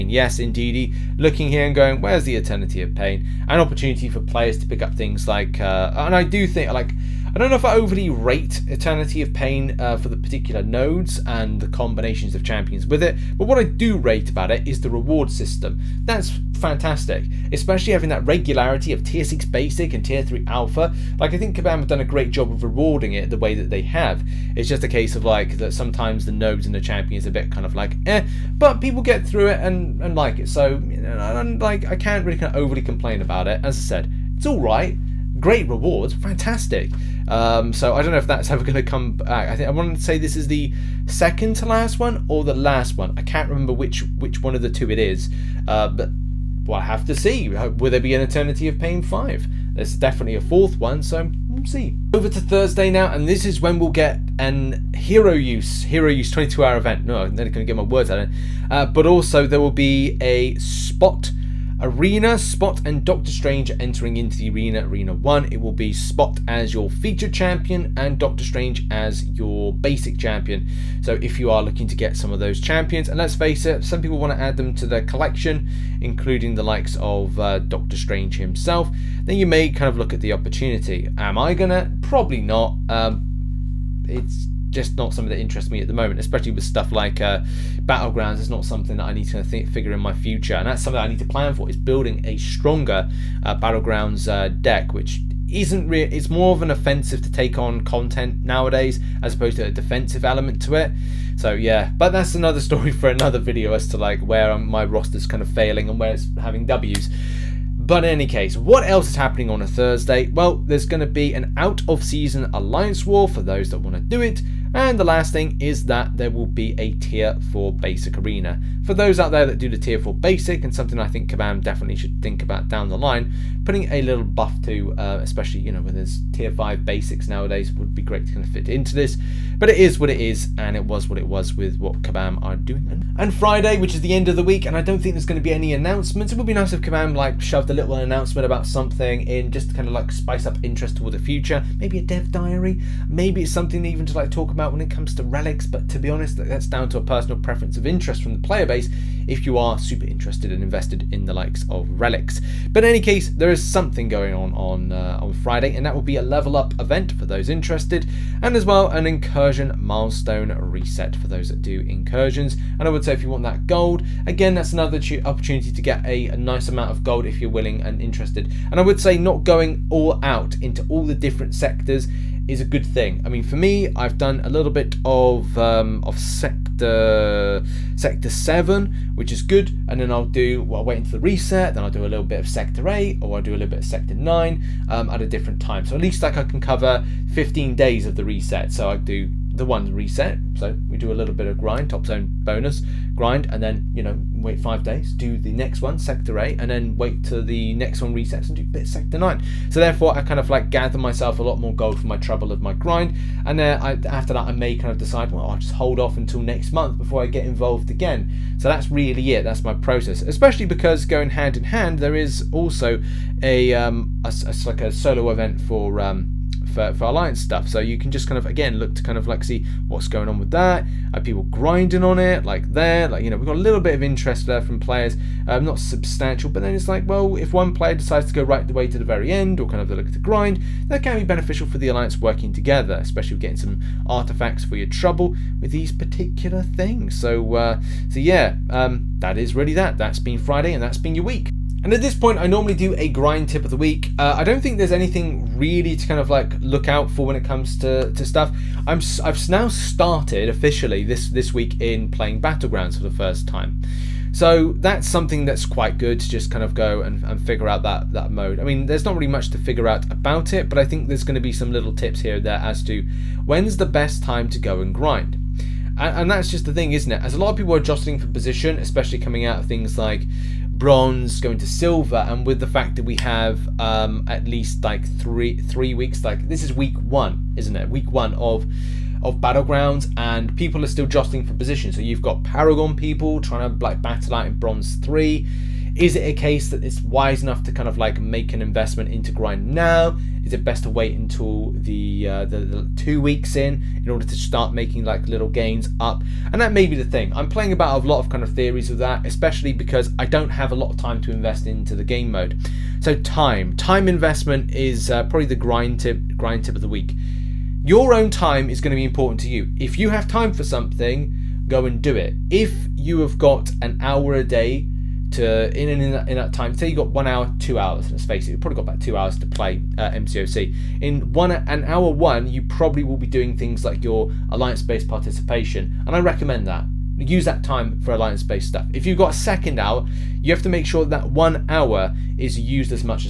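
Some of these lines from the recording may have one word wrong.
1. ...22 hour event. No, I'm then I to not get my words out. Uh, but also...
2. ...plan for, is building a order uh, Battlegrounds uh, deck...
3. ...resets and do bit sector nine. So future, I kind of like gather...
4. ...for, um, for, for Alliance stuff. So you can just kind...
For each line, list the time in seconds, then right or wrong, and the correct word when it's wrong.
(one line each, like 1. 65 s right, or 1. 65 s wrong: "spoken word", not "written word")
1. 56 s right
2. 91 s wrong: "stronger", not "order"
3. 198 s wrong: "therefore", not "future"
4. 215 s right.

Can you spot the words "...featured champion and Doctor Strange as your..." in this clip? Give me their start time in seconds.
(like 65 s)
66 s.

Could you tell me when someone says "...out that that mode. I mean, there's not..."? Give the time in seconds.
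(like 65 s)
257 s.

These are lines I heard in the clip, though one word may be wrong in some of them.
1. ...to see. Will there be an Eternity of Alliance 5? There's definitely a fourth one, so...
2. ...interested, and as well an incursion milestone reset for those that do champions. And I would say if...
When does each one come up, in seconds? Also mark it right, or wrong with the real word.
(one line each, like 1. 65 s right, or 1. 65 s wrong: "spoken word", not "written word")
1. 47 s wrong: "Pain", not "Alliance"
2. 157 s wrong: "incursions", not "champions".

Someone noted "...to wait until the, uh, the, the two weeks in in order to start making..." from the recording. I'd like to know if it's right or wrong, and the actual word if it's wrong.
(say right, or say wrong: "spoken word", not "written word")
right.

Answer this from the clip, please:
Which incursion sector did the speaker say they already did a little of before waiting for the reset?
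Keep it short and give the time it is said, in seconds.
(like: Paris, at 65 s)
sector seven, at 176 s.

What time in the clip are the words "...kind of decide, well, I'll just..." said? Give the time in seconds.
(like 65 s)
204 s.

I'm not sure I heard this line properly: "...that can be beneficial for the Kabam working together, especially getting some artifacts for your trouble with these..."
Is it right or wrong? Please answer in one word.
wrong.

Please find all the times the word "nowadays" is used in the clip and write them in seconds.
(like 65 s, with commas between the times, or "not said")
98 s, 127 s.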